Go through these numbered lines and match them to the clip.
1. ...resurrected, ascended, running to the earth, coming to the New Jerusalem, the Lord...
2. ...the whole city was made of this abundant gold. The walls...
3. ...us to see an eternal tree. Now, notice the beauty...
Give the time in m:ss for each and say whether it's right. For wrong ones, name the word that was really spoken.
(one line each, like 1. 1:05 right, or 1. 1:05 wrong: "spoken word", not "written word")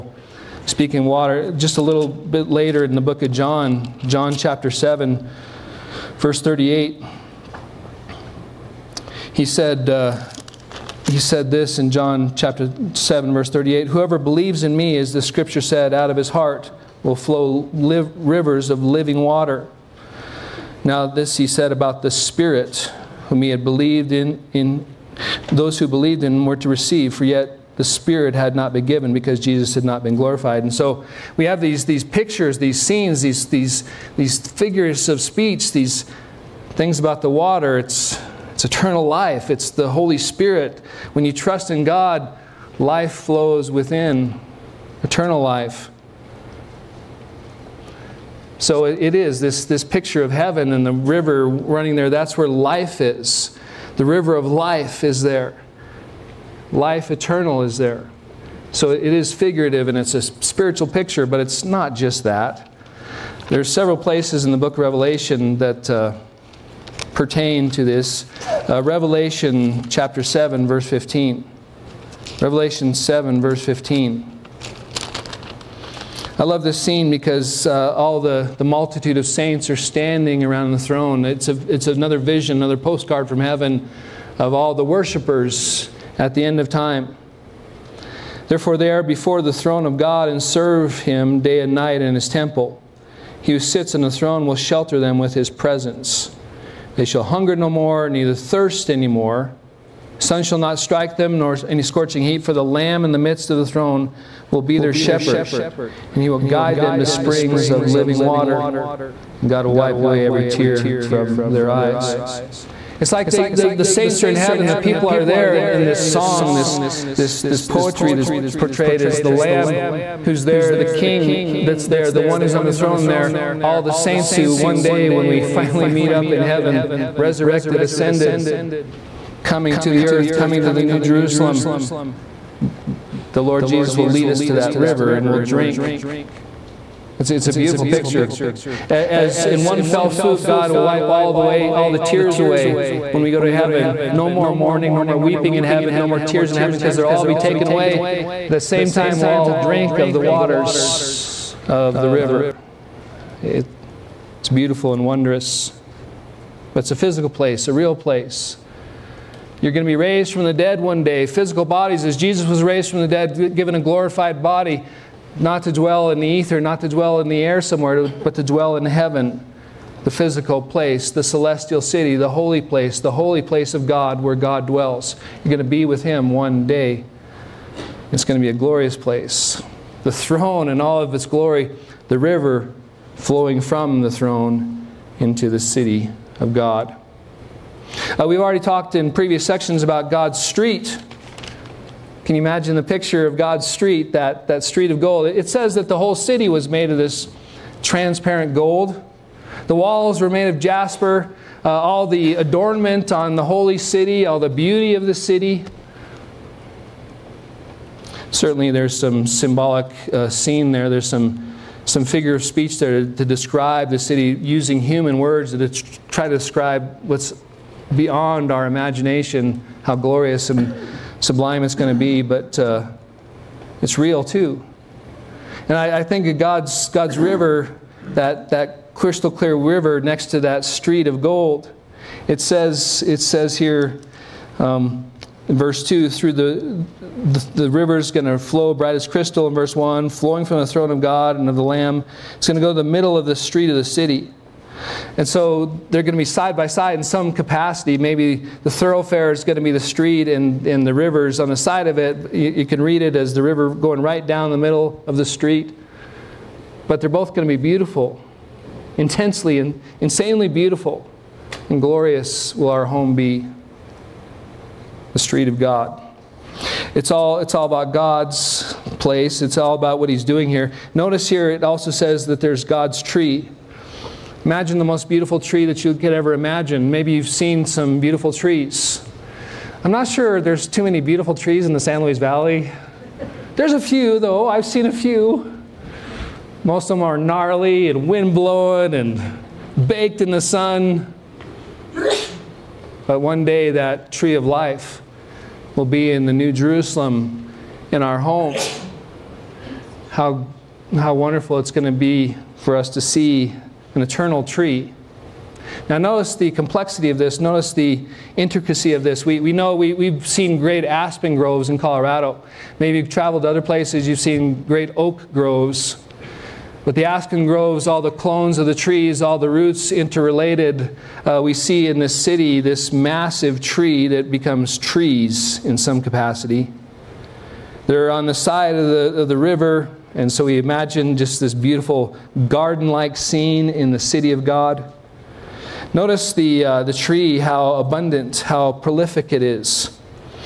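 1. 2:07 wrong: "coming", not "running"
2. 3:15 wrong: "transparent", not "abundant"
3. 5:02 wrong: "complexity", not "beauty".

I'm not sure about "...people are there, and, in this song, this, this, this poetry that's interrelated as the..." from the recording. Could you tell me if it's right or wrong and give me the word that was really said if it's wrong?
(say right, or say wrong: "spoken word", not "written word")
wrong: "portrayed", not "interrelated".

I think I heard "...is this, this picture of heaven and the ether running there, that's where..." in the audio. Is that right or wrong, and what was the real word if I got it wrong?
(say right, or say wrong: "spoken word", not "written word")
wrong: "river", not "ether".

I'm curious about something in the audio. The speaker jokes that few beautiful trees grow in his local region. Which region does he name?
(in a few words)
San Luis Valley.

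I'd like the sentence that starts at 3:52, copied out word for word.
It says, it says here, um, in verse 2, through the, the, the river is going to flow bright as crystal.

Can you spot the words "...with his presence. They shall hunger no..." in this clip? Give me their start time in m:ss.
1:35.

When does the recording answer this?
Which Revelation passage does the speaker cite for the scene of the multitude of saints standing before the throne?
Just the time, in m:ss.
1:08.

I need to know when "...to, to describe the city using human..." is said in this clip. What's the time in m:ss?
3:33.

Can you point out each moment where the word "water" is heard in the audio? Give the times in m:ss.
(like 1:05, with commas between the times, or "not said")
0:01, 0:19, 0:37, 1:48, 2:30.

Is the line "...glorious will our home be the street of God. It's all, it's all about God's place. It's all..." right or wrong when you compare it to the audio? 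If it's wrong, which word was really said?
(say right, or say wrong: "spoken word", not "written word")
right.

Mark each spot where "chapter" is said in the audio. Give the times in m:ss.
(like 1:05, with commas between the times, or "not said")
0:04, 0:12, 1:09.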